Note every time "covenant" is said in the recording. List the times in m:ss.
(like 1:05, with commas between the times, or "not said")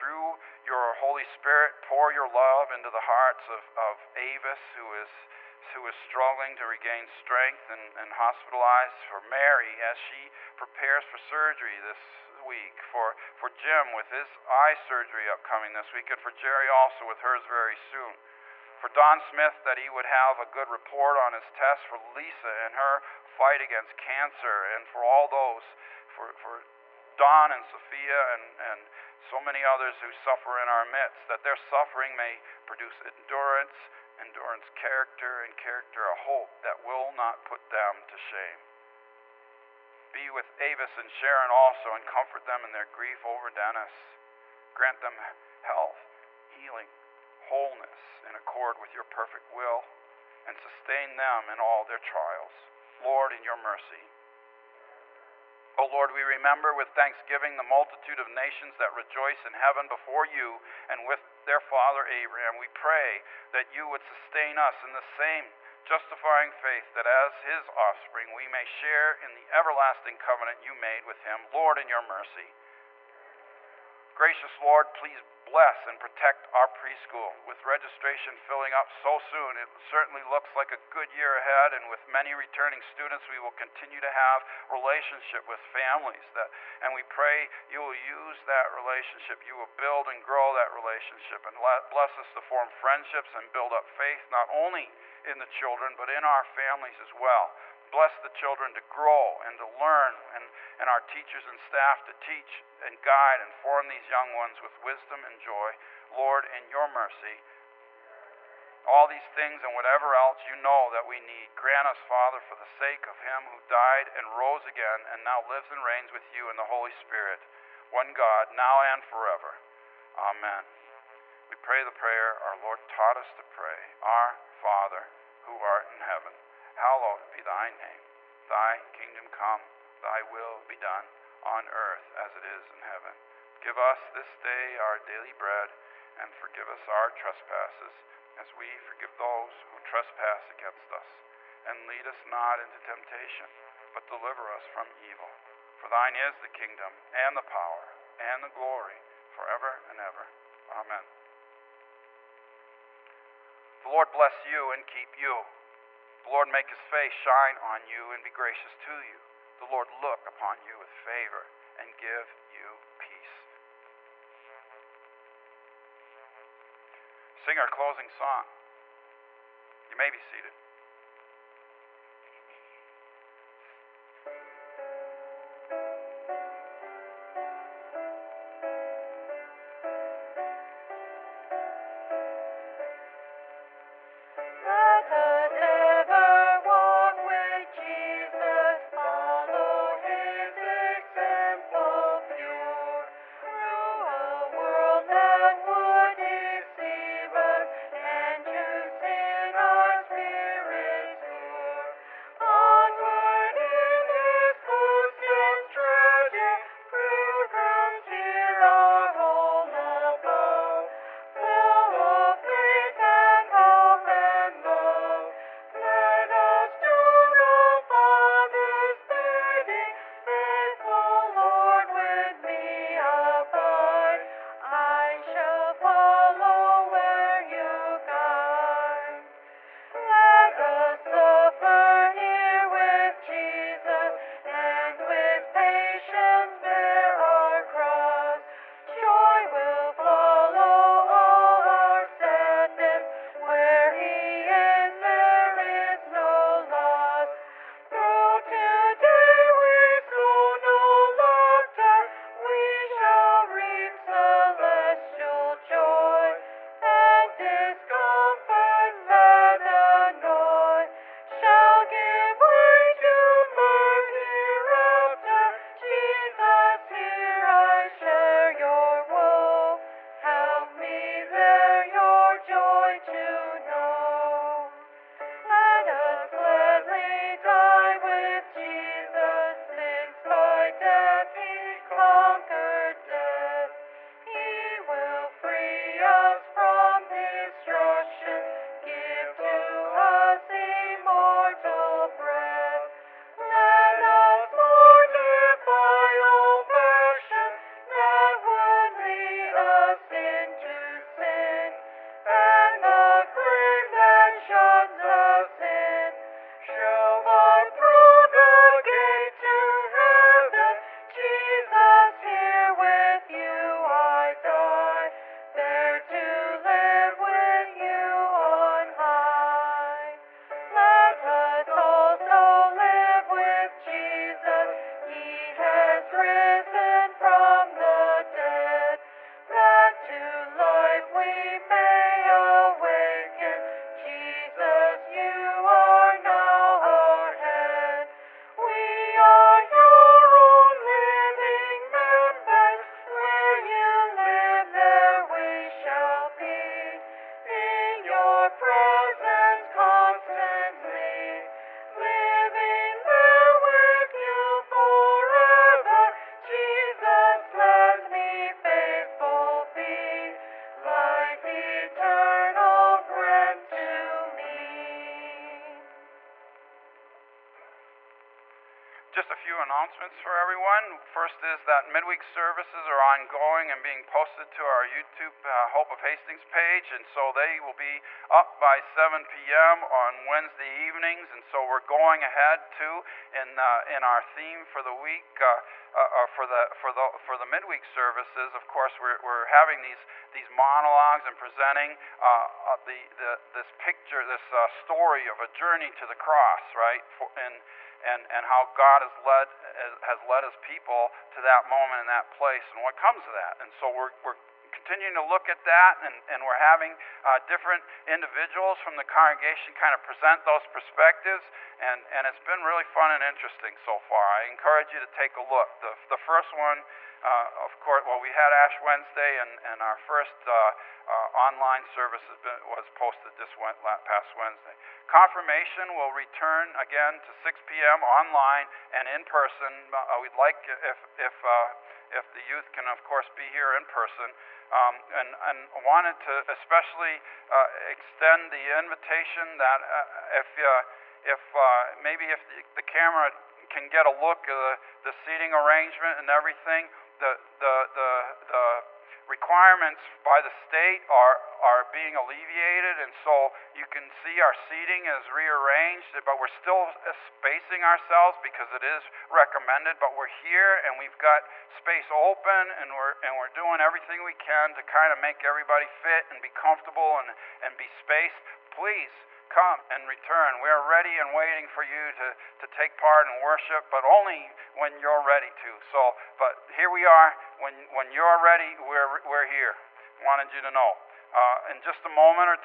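1:10.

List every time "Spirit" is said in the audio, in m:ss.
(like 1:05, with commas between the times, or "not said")
0:01, 1:56.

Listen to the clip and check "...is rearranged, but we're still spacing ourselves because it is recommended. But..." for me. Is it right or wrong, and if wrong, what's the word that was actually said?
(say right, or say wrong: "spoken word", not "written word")
right.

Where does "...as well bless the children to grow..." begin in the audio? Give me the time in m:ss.
1:37.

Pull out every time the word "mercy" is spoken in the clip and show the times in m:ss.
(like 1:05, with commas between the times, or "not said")
0:53, 1:12, 1:46.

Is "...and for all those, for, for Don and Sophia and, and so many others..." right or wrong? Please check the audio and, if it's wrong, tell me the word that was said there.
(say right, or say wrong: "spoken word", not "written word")
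right.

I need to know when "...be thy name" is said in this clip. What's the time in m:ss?
2:07.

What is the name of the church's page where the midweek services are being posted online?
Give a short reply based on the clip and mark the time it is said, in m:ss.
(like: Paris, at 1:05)
Hope of Hastings, at 6:15.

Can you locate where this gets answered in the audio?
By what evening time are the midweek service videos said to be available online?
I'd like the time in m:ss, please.
6:18.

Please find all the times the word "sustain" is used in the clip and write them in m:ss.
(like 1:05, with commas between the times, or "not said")
0:50, 1:04.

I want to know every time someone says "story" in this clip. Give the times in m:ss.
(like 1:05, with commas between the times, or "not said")
6:34.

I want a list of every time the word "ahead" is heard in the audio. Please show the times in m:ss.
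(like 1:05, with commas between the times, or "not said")
1:21, 6:22.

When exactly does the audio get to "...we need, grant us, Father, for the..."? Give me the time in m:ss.
1:51.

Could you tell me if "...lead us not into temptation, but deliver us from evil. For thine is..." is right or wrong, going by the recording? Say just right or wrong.
right.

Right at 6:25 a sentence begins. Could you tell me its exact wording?
Uh, uh, uh, for the for the for the midweek services.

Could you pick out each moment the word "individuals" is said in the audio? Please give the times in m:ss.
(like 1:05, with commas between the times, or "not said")
6:48.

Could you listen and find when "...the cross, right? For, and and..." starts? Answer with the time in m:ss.
6:36.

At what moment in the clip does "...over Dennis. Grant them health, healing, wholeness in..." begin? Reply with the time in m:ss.
0:43.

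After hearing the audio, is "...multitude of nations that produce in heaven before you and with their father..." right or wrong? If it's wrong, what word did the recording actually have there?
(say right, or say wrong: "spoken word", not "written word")
wrong: "rejoice", not "produce".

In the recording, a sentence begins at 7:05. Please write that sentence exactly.
Confirmation will return again to 6 p.m.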